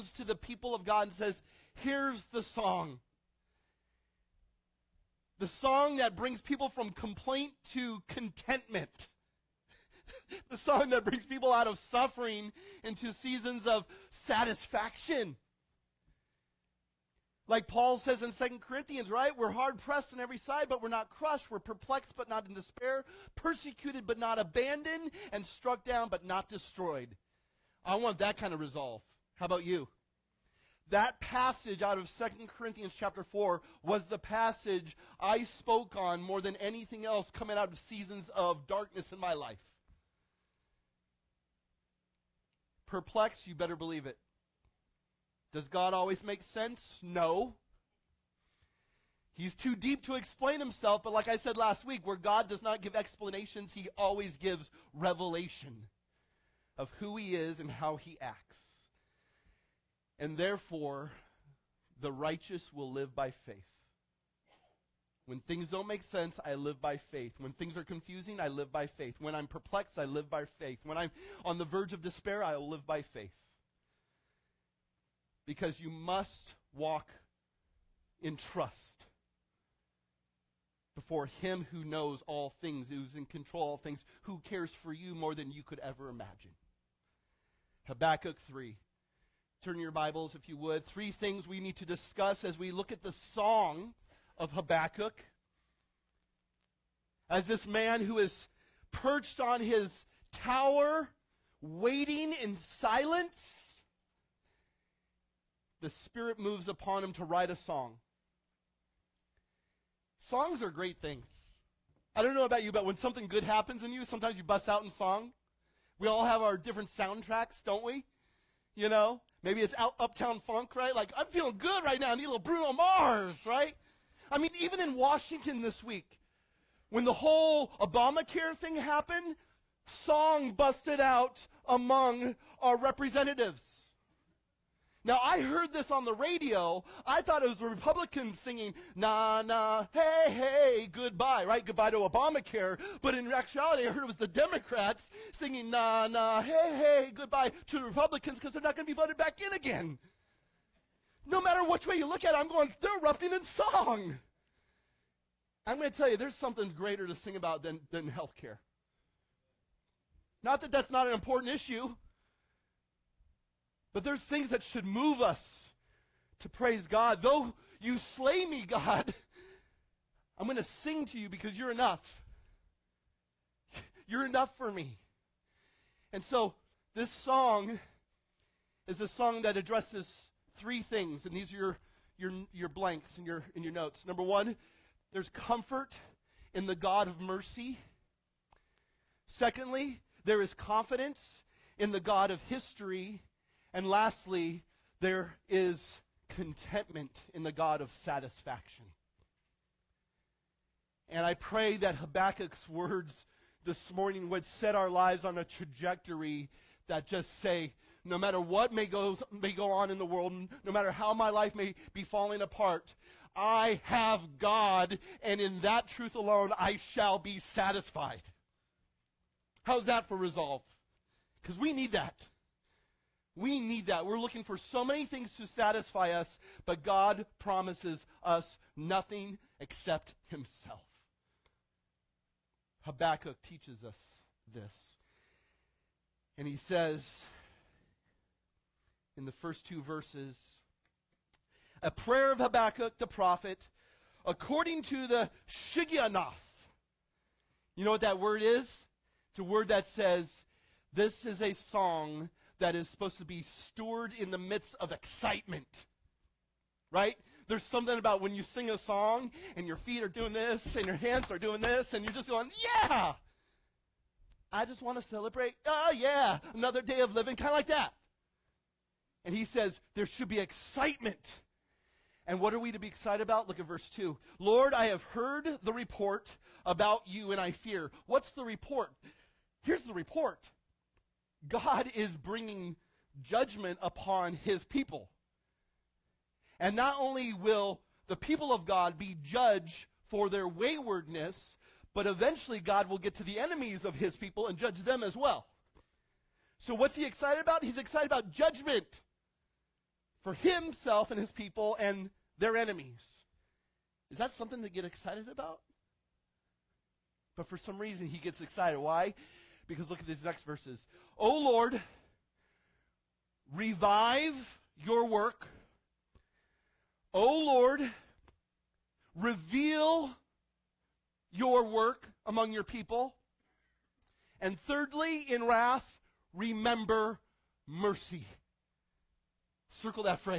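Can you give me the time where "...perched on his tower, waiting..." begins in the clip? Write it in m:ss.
1:38.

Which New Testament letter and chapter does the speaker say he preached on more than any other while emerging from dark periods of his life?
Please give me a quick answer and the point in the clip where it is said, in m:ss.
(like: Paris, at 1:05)
2 Corinthians 4, at 0:32.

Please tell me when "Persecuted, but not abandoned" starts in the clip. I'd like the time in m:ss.
0:23.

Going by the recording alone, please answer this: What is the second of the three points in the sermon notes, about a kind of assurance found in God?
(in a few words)
confidence in the God of history.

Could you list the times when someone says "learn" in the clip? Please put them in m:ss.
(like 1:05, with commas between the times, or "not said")
not said.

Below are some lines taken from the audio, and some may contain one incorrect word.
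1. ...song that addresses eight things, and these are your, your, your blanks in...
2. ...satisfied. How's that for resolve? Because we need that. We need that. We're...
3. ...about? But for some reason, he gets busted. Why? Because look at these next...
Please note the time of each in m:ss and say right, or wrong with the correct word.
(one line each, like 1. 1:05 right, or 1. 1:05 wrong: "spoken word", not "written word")
1. 2:59 wrong: "three", not "eight"
2. 3:37 right
3. 5:05 wrong: "excited", not "busted".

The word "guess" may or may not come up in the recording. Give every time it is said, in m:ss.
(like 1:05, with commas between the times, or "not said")
not said.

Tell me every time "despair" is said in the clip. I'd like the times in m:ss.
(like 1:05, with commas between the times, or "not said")
0:22, 1:12.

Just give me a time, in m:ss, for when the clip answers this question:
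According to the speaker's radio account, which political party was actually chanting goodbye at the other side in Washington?
2:24.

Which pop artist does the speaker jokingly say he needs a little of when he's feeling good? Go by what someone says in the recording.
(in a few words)
Bruno Mars.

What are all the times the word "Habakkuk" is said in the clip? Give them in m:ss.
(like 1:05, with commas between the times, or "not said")
1:27, 1:34, 3:21, 3:52, 4:02.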